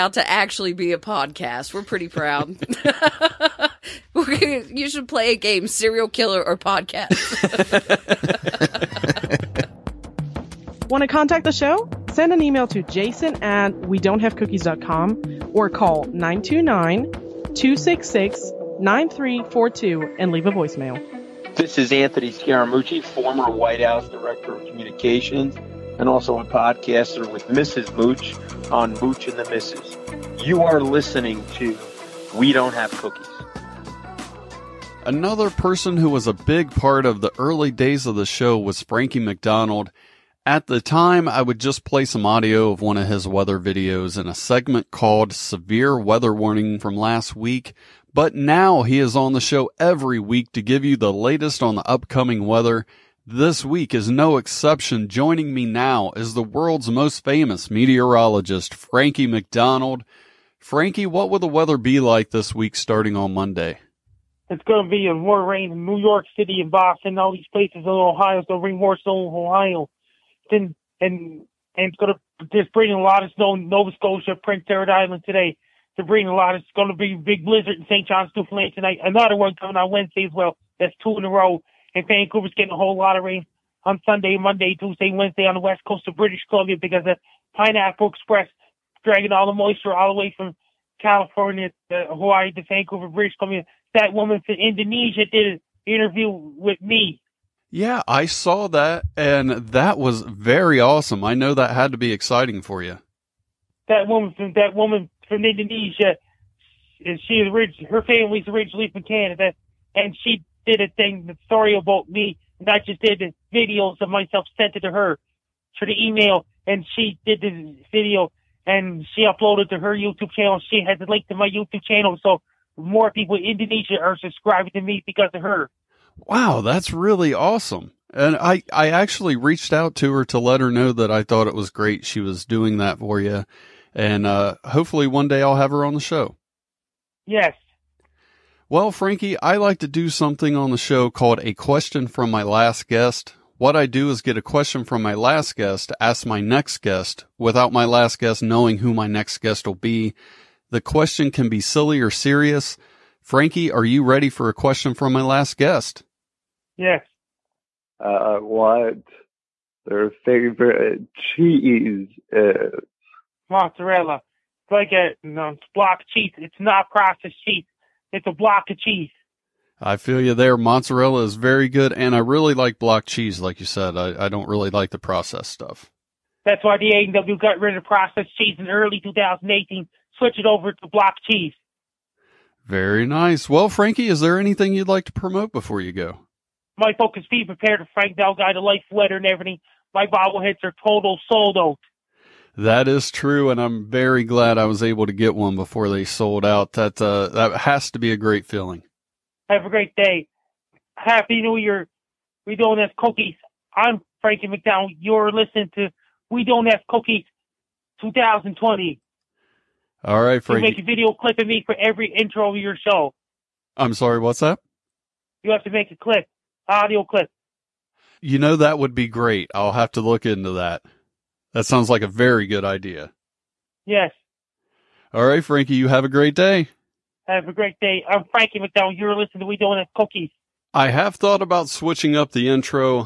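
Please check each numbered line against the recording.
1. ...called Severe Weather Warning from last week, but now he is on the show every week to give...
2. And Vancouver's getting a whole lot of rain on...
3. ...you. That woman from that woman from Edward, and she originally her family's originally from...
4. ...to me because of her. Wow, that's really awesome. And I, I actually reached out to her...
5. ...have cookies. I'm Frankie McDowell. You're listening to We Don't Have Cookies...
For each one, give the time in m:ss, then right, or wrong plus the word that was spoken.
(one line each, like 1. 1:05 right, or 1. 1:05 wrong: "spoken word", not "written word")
1. 0:44 right
2. 1:21 right
3. 1:42 wrong: "Indonesia", not "Edward"
4. 2:04 right
5. 3:22 right.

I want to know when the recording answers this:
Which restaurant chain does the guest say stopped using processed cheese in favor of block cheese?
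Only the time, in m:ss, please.
2:56.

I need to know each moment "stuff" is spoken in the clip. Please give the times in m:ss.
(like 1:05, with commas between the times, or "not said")
2:55.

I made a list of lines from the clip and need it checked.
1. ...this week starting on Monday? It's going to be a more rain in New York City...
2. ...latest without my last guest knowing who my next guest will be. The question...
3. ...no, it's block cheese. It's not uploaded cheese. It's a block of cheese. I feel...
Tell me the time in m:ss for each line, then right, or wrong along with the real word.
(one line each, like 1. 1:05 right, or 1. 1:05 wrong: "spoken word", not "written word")
1. 1:02 right
2. 2:26 wrong: "guest", not "latest"
3. 2:45 wrong: "processed", not "uploaded".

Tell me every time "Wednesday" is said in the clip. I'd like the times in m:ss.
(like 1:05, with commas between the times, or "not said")
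1:19, 1:25.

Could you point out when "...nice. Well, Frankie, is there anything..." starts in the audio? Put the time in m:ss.
3:03.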